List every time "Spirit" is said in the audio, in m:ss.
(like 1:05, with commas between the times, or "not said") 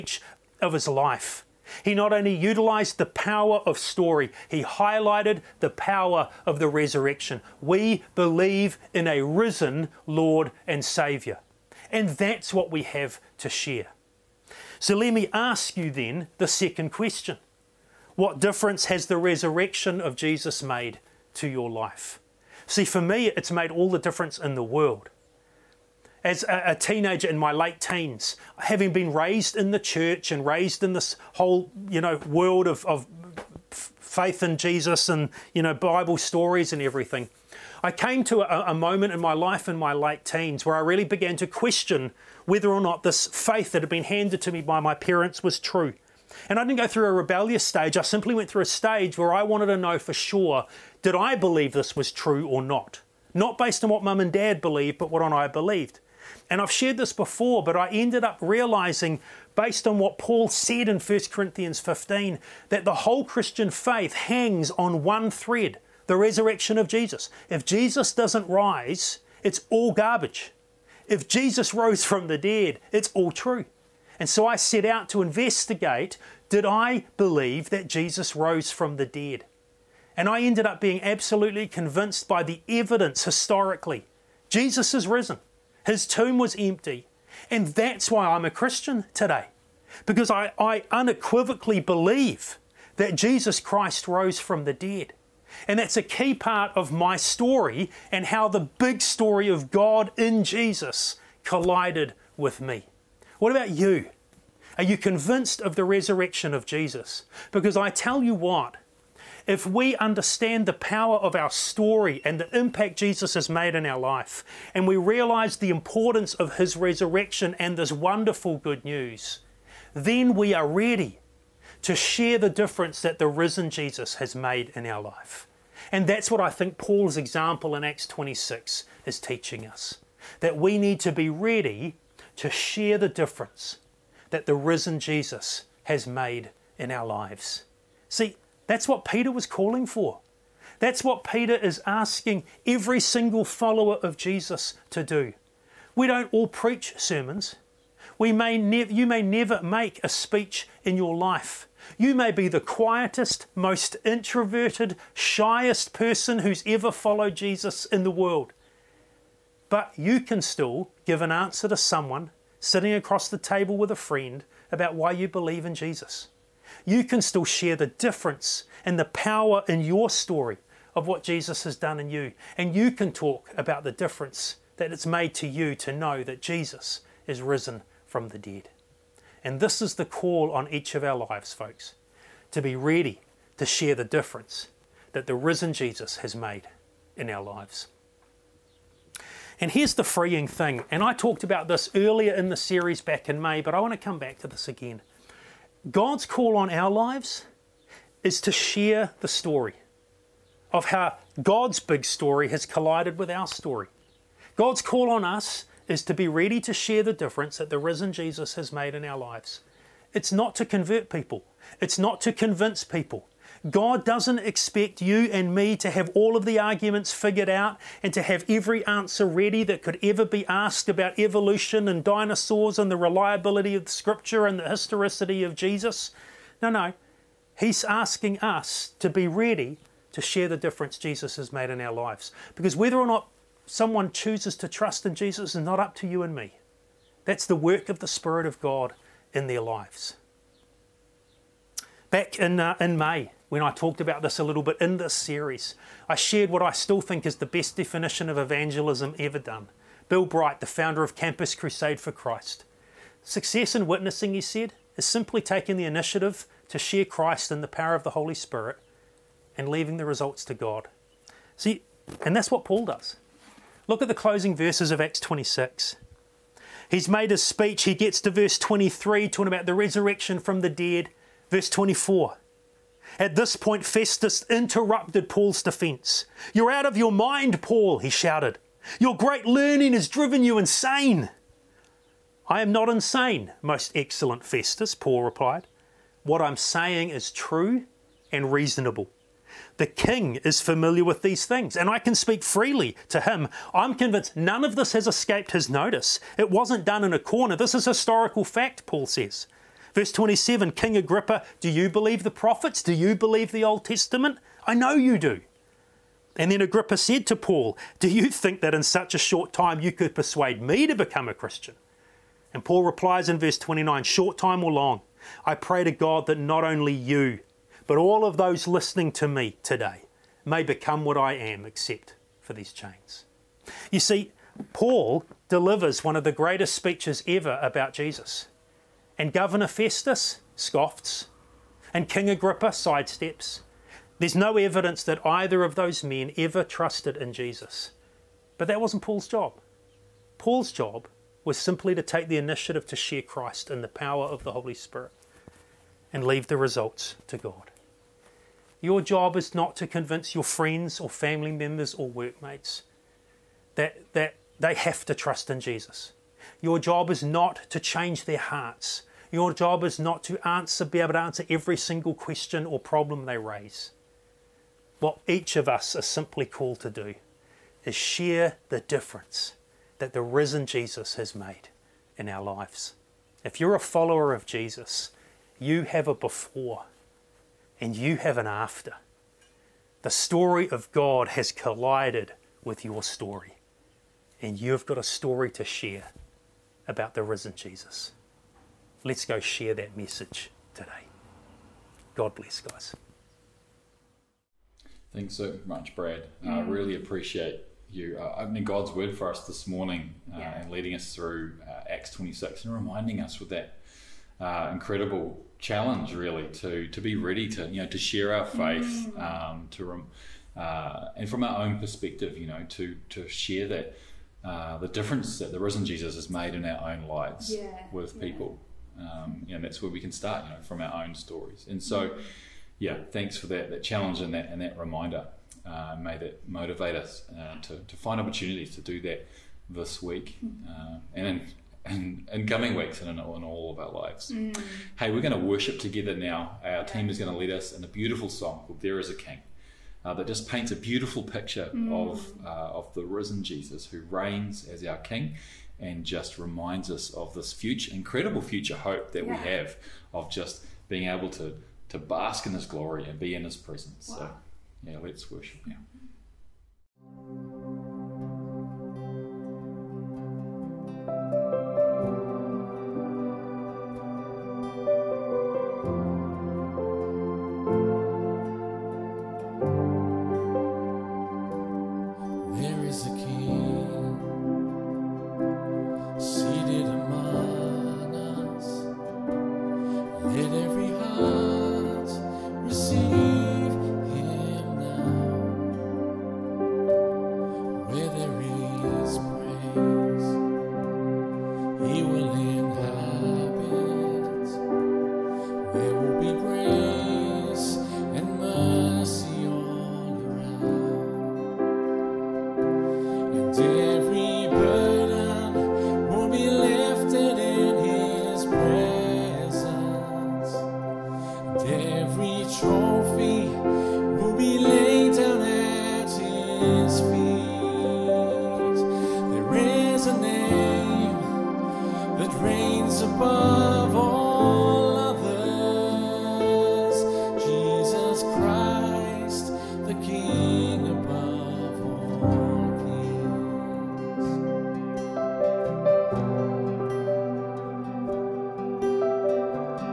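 3:58, 4:18, 5:44.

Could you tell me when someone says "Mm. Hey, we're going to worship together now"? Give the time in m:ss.
7:14.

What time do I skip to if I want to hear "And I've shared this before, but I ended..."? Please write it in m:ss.
0:56.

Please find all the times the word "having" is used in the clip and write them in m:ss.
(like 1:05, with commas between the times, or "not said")
0:28.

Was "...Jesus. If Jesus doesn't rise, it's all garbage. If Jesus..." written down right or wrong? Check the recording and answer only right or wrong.
right.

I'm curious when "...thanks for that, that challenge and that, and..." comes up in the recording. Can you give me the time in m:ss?
7:03.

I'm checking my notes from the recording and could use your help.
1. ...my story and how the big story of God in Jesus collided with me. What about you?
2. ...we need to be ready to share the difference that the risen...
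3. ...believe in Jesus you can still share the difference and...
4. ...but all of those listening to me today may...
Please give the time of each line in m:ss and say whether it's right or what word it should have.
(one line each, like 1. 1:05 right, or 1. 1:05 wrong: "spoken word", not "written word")
1. 1:36 right
2. 2:10 right
3. 2:45 right
4. 5:17 right.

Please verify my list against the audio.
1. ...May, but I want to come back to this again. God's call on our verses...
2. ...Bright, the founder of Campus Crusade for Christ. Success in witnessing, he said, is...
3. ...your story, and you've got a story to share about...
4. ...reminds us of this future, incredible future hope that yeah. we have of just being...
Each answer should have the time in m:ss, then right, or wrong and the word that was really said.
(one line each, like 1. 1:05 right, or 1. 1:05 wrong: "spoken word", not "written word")
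1. 3:13 wrong: "lives", not "verses"
2. 4:10 right
3. 6:22 right
4. 7:26 right.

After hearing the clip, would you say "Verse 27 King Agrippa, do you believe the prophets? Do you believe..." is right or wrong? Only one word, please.
right.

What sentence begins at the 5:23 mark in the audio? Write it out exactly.
You see, Paul delivers one of the greatest speeches ever about Jesus and Governor Festus scoffs, and King Agrippa sidesteps.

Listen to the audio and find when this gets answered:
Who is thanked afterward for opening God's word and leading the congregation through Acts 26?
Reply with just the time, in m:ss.
6:35.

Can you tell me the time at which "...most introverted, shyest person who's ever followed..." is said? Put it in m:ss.
2:33.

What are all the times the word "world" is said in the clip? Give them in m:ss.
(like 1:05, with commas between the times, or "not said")
0:24, 0:32, 2:38.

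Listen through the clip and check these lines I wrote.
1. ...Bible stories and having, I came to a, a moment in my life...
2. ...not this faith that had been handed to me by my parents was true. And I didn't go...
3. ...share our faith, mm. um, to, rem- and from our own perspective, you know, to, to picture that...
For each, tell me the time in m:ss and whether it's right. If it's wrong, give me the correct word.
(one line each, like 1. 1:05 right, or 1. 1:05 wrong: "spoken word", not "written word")
1. 0:35 wrong: "everything", not "having"
2. 0:42 right
3. 6:47 wrong: "share", not "picture".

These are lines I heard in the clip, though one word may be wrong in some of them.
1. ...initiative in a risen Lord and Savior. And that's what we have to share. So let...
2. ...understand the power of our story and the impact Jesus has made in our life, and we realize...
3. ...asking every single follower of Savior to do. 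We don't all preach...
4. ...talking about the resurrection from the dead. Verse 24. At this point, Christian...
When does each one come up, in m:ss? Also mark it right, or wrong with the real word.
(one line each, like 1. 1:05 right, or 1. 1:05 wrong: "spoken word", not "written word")
1. 0:08 wrong: "believe", not "initiative"
2. 1:49 right
3. 2:21 wrong: "Jesus", not "Savior"
4. 4:29 wrong: "Festus", not "Christian".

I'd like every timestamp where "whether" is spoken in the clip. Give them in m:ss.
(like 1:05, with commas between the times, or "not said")
0:42, 3:52.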